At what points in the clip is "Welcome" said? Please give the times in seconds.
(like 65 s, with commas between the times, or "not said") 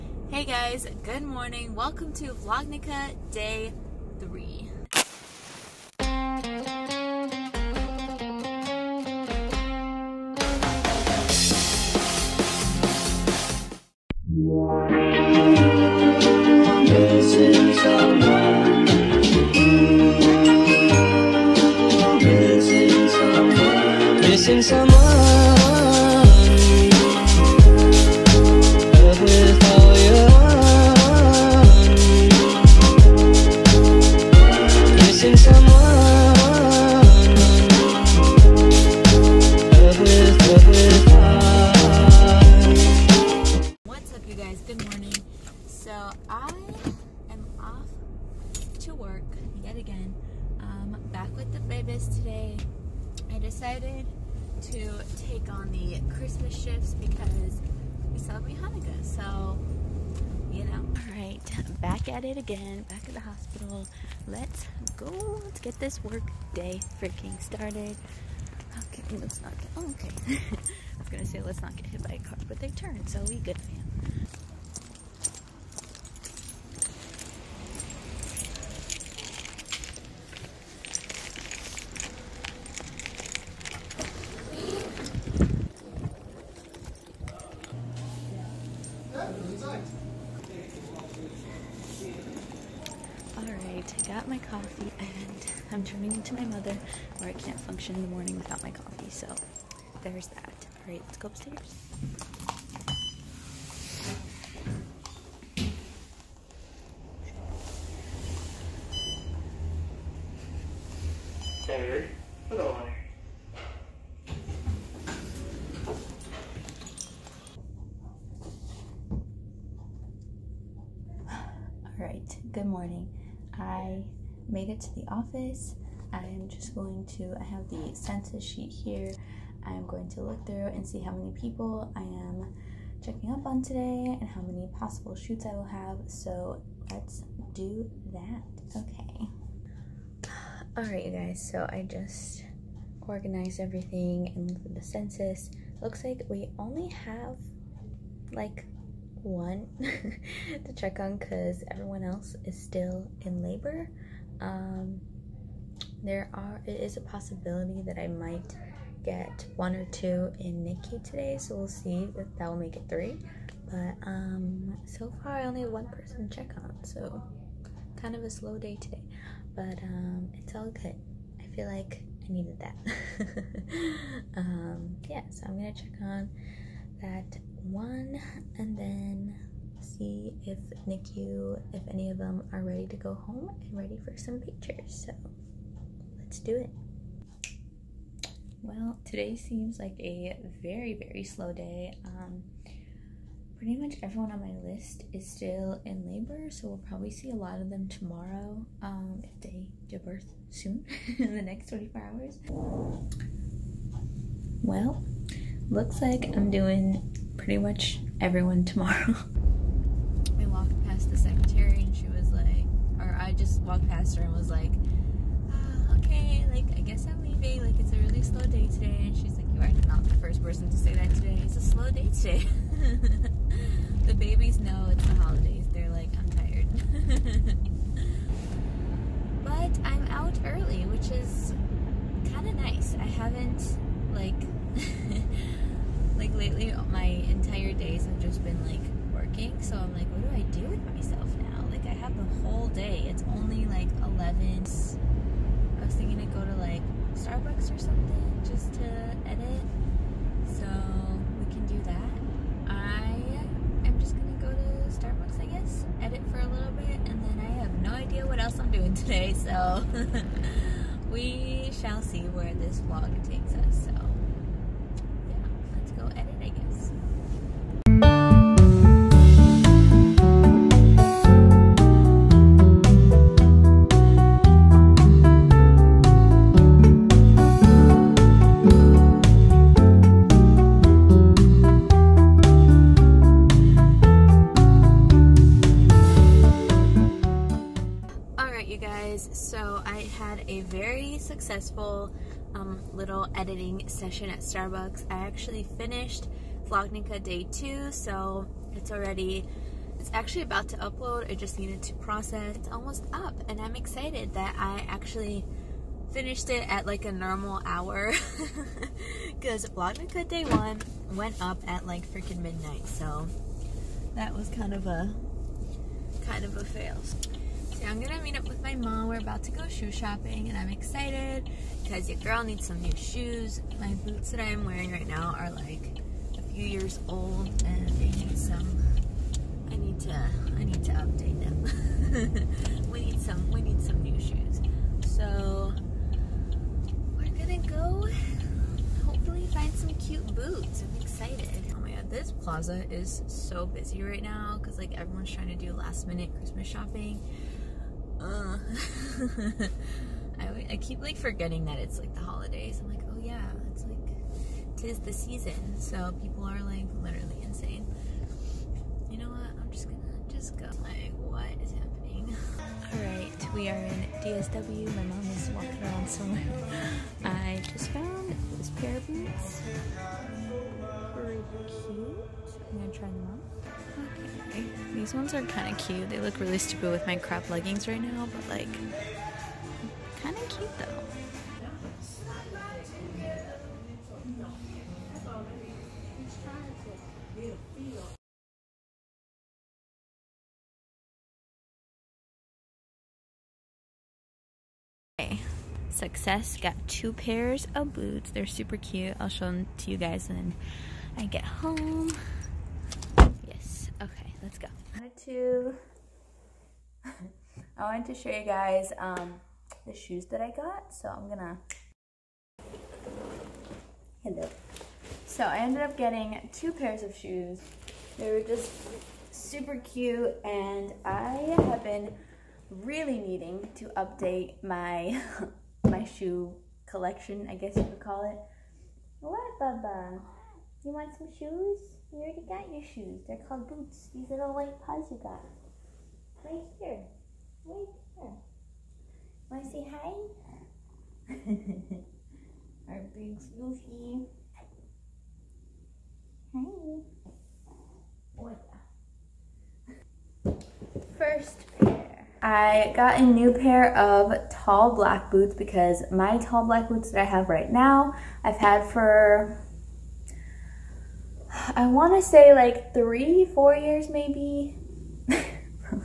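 1 s.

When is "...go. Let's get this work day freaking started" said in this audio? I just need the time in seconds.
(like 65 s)
64 s.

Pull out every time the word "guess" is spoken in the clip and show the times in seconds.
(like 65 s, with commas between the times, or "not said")
216 s, 255 s, 427 s.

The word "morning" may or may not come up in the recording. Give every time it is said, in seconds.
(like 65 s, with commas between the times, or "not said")
1 s, 98 s, 122 s.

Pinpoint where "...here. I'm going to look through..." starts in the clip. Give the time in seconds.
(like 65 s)
128 s.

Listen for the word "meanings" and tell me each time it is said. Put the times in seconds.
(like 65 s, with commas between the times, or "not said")
not said.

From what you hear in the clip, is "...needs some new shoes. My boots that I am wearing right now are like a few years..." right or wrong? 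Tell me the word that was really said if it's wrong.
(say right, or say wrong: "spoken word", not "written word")
right.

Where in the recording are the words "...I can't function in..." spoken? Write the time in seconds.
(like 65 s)
97 s.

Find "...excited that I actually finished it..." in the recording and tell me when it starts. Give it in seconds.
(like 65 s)
303 s.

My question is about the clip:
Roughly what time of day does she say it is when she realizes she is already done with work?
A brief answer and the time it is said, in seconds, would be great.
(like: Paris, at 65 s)
11, at 243 s.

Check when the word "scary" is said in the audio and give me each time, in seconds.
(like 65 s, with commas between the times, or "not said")
not said.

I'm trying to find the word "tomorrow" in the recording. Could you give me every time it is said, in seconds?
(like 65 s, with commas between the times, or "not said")
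197 s, 208 s.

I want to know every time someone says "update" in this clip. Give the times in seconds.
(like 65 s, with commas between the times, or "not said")
330 s, 423 s.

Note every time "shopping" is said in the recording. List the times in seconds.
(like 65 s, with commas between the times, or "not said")
319 s, 346 s.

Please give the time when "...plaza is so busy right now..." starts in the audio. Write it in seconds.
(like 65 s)
342 s.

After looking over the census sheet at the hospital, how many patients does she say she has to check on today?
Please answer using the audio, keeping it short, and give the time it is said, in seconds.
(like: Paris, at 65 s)
1, at 146 s.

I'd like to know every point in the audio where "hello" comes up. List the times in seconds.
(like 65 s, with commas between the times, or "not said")
414 s.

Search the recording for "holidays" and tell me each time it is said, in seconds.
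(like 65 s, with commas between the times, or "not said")
225 s, 352 s.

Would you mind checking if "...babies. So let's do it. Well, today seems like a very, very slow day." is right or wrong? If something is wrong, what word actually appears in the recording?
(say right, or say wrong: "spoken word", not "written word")
wrong: "pictures", not "babies".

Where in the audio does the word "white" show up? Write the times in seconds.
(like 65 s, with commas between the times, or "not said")
434 s.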